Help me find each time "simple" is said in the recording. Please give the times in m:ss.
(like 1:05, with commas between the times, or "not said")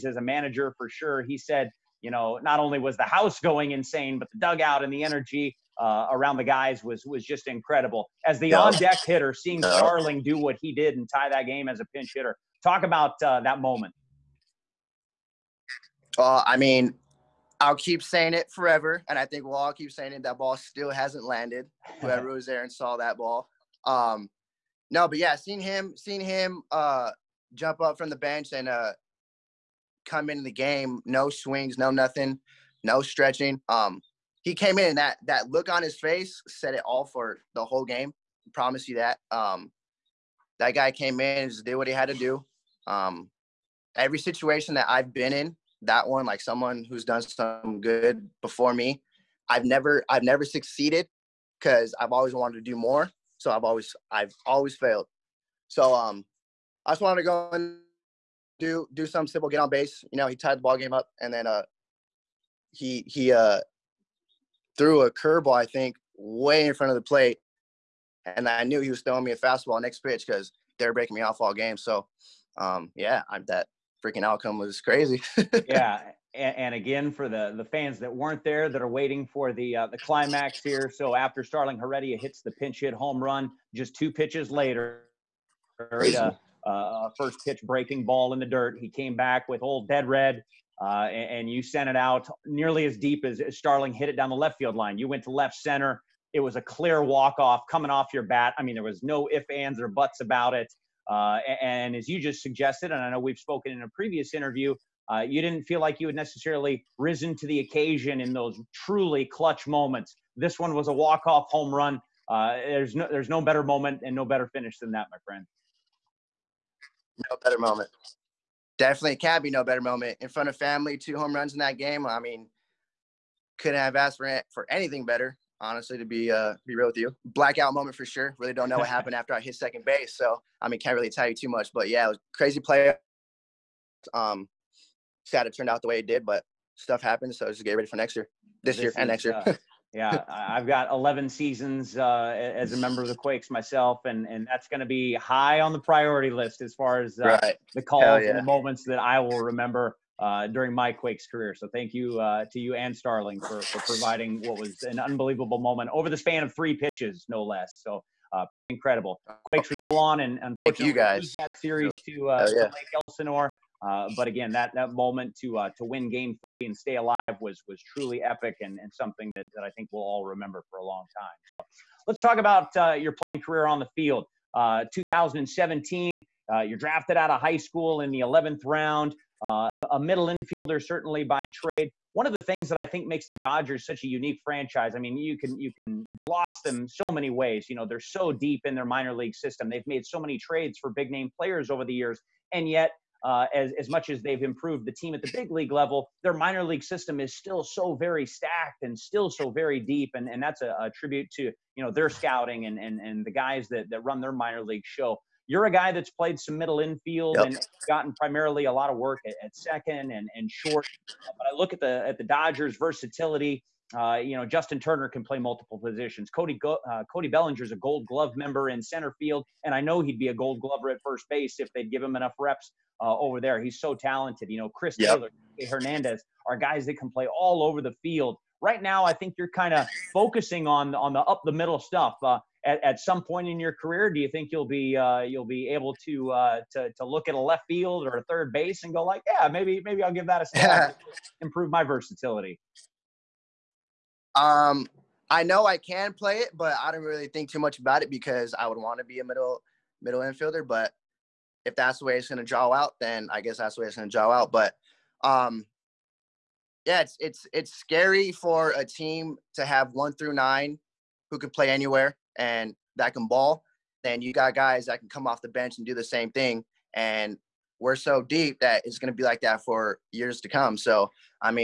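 0:59.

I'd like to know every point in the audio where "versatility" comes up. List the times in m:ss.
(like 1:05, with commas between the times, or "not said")
3:32, 4:01.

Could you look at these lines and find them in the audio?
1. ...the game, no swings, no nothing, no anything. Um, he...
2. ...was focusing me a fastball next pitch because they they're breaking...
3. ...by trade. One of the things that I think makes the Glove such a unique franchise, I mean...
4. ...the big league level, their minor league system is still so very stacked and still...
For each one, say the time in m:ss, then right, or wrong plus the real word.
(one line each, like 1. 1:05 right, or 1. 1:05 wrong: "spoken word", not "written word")
1. 0:30 wrong: "stretching", not "anything"
2. 1:08 wrong: "throwing", not "focusing"
3. 3:01 wrong: "Dodgers", not "Glove"
4. 3:15 right.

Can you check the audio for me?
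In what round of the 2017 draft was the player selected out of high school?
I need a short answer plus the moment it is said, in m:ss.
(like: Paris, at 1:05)
11th round, at 2:58.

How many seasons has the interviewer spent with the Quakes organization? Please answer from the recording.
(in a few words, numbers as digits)
11.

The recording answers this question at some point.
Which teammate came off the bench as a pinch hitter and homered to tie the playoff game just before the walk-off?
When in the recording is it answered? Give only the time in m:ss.
1:21.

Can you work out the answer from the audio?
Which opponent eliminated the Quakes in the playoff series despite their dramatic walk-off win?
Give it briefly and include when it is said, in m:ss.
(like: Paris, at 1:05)
Lake Elsinore, at 2:42.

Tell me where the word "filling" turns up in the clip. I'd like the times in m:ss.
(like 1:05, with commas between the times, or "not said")
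not said.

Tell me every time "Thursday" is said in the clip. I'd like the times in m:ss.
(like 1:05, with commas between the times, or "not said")
not said.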